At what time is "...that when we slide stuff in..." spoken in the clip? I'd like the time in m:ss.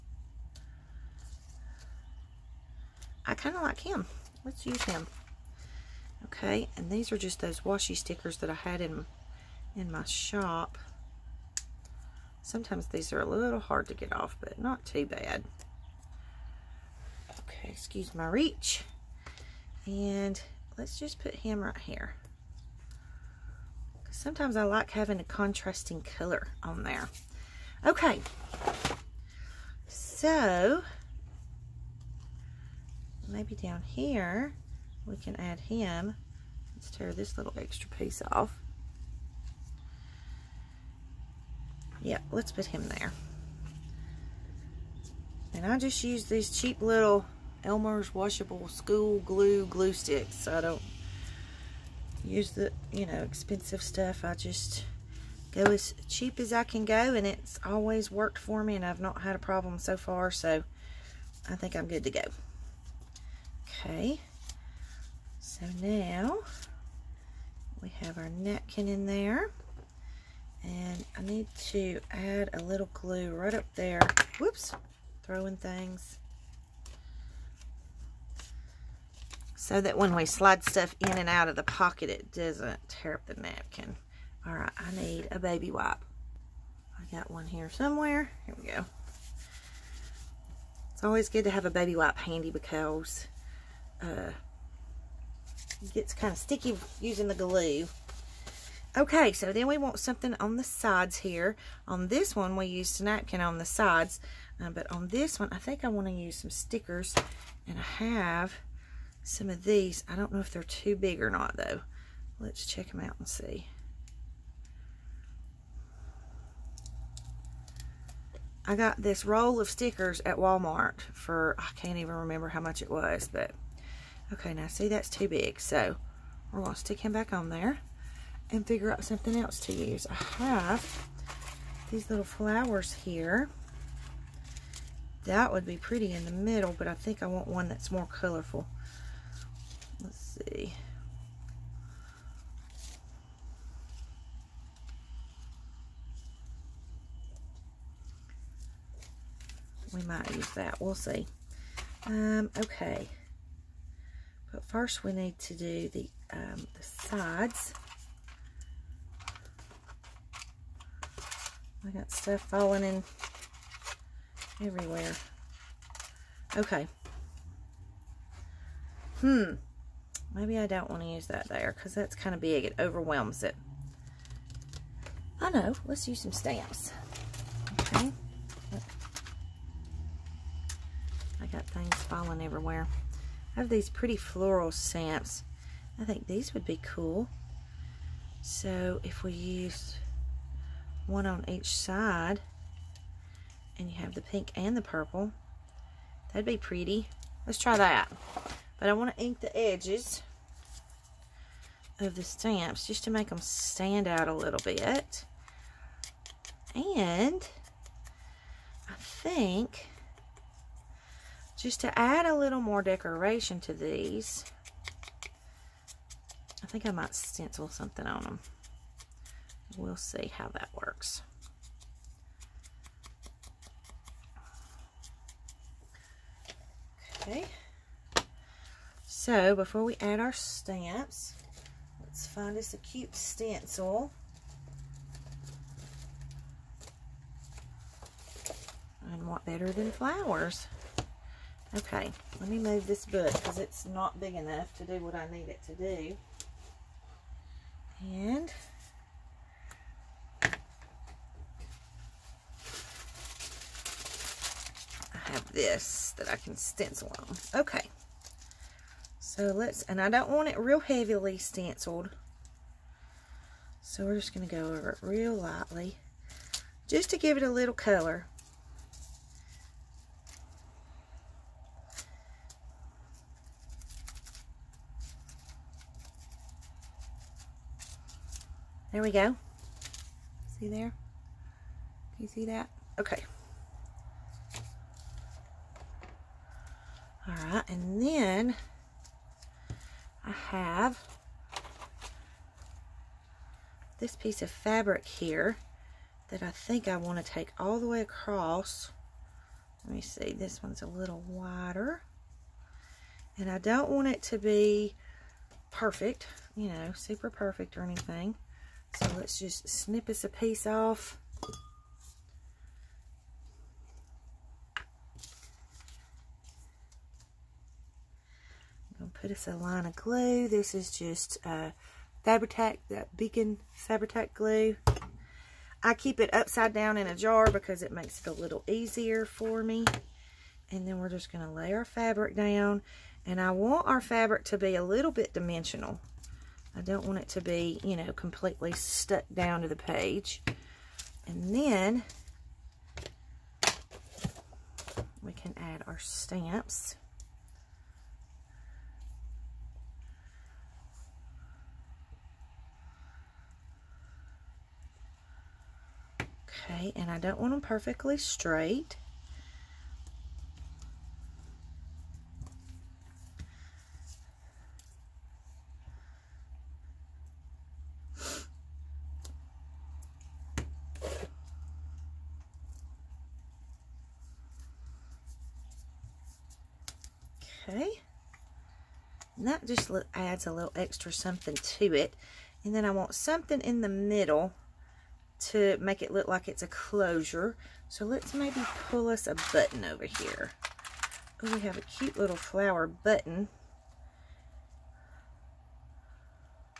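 1:19.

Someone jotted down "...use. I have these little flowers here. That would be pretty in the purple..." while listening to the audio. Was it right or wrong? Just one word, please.
wrong.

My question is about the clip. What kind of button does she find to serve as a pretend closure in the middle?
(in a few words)
flower button.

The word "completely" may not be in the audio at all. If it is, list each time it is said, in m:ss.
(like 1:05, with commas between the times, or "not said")
5:38.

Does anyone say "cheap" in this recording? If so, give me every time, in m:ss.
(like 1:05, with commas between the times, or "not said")
0:46, 0:56.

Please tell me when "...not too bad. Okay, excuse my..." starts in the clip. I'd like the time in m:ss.
0:14.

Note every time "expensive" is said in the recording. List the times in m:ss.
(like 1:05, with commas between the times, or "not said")
0:53.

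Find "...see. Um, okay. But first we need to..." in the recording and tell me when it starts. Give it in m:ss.
2:30.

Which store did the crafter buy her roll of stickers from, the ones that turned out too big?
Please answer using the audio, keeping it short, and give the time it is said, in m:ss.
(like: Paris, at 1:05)
Walmart, at 2:00.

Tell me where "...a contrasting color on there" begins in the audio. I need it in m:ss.
0:25.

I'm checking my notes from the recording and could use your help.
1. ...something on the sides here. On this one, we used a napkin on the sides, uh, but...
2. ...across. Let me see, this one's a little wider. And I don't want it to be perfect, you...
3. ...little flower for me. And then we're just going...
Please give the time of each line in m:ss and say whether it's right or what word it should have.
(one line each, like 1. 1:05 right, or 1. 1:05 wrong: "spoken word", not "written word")
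1. 1:40 right
2. 4:58 right
3. 5:28 wrong: "easier", not "flower".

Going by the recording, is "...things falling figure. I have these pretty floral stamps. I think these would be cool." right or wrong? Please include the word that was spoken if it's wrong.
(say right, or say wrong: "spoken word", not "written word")
wrong: "everywhere", not "figure".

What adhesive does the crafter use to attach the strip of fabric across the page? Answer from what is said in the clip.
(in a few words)
Beacon Fabri-Tac.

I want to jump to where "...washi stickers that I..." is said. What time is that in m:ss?
0:07.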